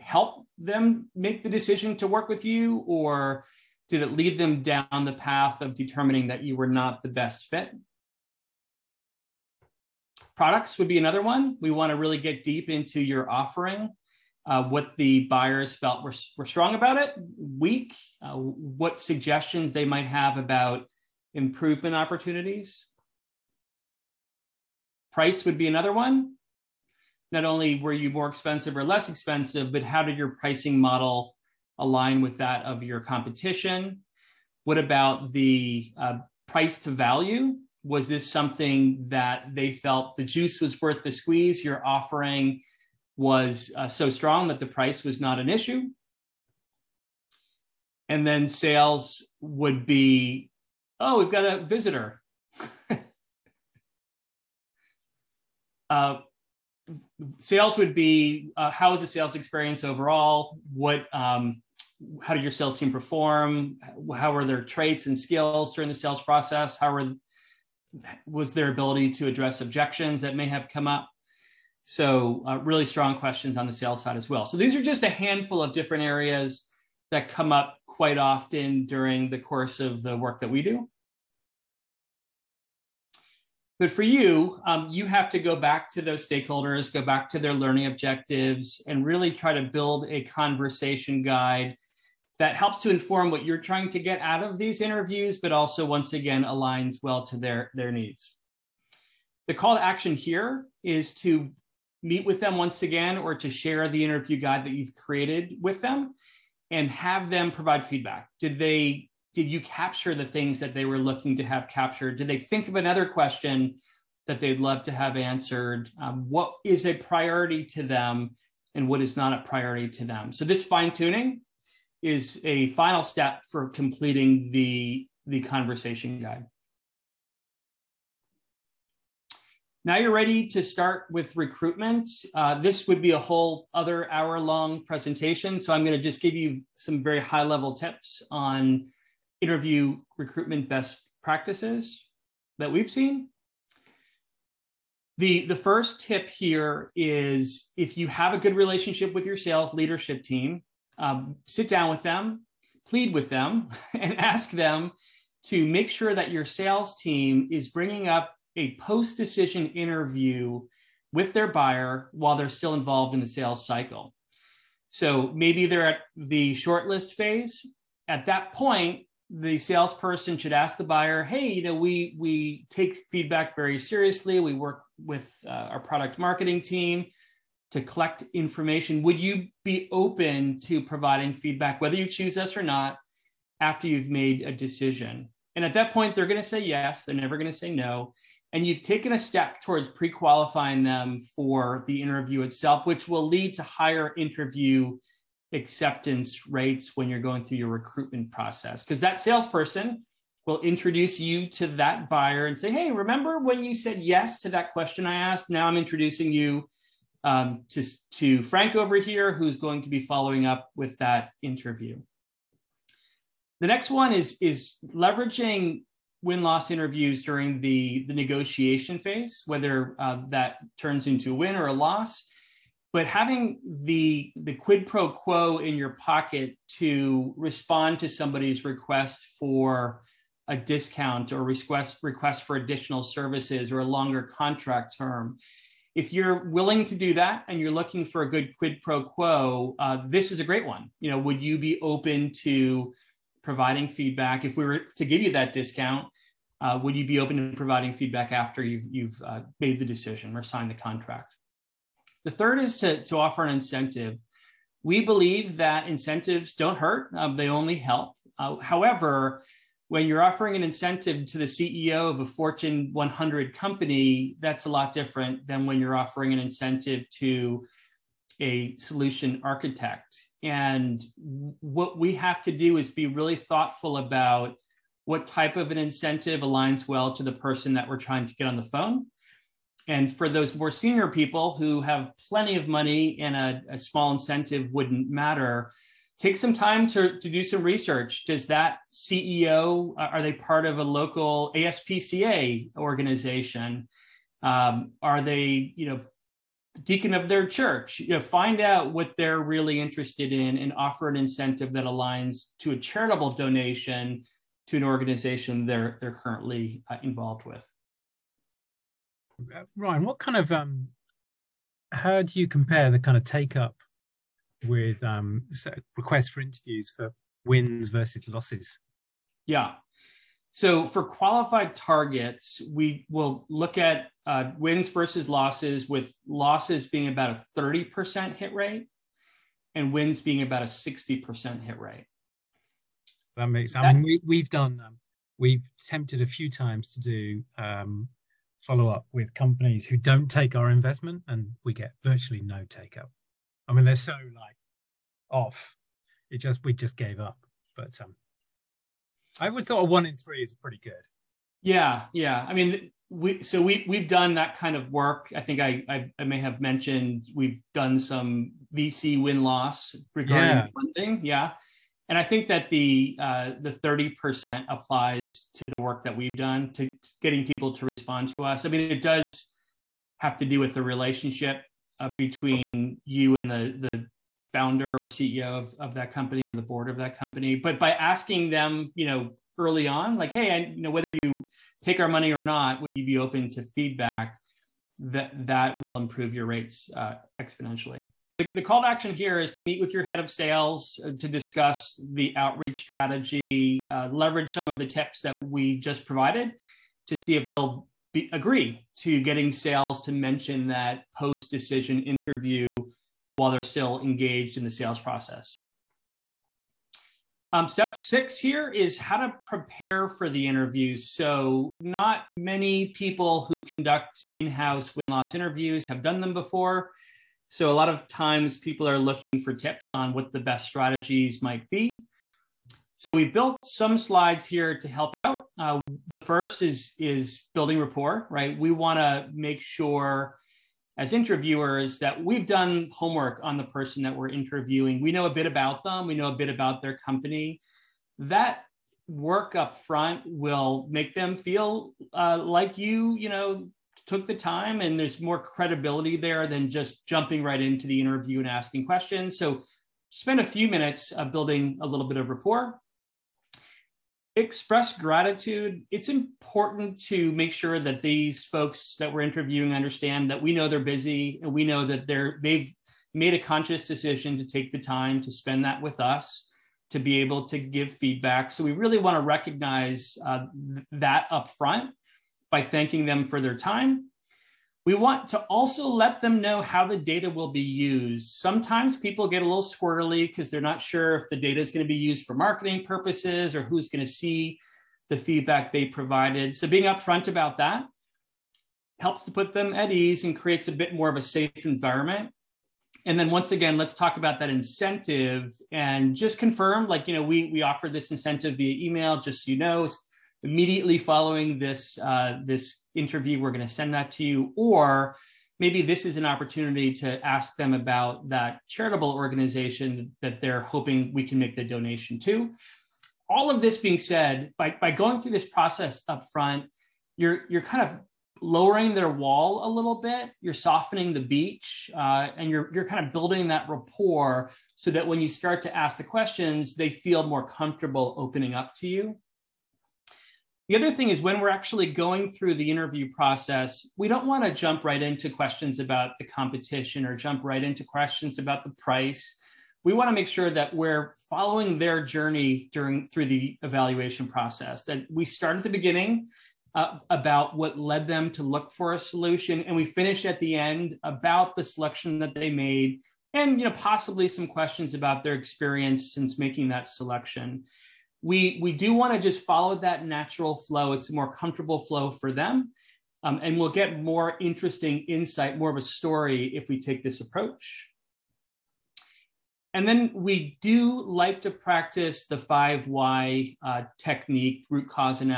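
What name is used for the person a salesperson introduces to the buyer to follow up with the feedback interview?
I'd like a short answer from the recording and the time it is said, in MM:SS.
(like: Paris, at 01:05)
Frank, at 03:28.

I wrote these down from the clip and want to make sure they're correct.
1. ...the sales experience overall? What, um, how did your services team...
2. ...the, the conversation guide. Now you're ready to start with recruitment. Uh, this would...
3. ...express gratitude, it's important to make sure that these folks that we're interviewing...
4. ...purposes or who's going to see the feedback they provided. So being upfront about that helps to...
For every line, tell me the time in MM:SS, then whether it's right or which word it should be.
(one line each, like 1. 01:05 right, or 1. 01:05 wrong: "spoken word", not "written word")
1. 00:58 wrong: "sales", not "services"
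2. 02:04 right
3. 07:34 right
4. 08:02 right.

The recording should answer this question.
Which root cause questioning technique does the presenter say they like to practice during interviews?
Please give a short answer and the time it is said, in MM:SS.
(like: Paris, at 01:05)
five why, at 09:32.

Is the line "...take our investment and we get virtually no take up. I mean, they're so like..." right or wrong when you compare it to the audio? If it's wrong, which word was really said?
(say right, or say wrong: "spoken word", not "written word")
right.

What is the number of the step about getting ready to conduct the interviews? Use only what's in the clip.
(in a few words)
6.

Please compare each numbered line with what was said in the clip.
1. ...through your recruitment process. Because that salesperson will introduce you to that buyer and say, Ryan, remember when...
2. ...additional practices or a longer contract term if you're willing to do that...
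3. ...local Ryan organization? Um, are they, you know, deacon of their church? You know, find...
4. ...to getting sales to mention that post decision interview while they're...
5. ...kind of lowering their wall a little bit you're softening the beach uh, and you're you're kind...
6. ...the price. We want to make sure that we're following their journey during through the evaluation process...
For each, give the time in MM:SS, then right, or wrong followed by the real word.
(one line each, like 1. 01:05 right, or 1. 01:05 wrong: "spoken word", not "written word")
1. 03:17 wrong: "Hey", not "Ryan"
2. 03:52 wrong: "services", not "practices"
3. 04:50 wrong: "ASPCA", not "Ryan"
4. 06:38 right
5. 08:37 right
6. 08:58 right.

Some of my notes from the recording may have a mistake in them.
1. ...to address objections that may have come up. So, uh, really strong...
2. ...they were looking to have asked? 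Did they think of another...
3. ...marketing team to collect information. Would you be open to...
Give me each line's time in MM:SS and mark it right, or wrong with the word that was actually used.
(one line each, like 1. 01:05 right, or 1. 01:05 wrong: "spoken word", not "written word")
1. 01:09 right
2. 01:50 wrong: "captured", not "asked"
3. 02:56 right.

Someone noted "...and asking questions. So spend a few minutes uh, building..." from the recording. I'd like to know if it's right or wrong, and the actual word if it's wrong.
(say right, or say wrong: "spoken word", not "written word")
right.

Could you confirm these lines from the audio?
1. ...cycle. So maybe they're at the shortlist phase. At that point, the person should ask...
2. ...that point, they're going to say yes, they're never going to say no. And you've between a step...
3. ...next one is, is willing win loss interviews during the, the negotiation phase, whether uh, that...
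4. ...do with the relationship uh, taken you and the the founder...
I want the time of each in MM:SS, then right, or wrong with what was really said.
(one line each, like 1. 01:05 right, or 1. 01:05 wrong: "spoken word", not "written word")
1. 02:43 wrong: "salesperson", not "person"
2. 03:05 wrong: "taken", not "between"
3. 03:33 wrong: "leveraging", not "willing"
4. 06:10 wrong: "between", not "taken".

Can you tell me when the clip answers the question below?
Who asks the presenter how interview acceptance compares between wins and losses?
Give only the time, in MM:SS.
05:09.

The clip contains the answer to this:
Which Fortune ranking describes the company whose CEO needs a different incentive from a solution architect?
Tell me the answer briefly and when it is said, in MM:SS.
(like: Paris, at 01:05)
Fortune 100, at 04:22.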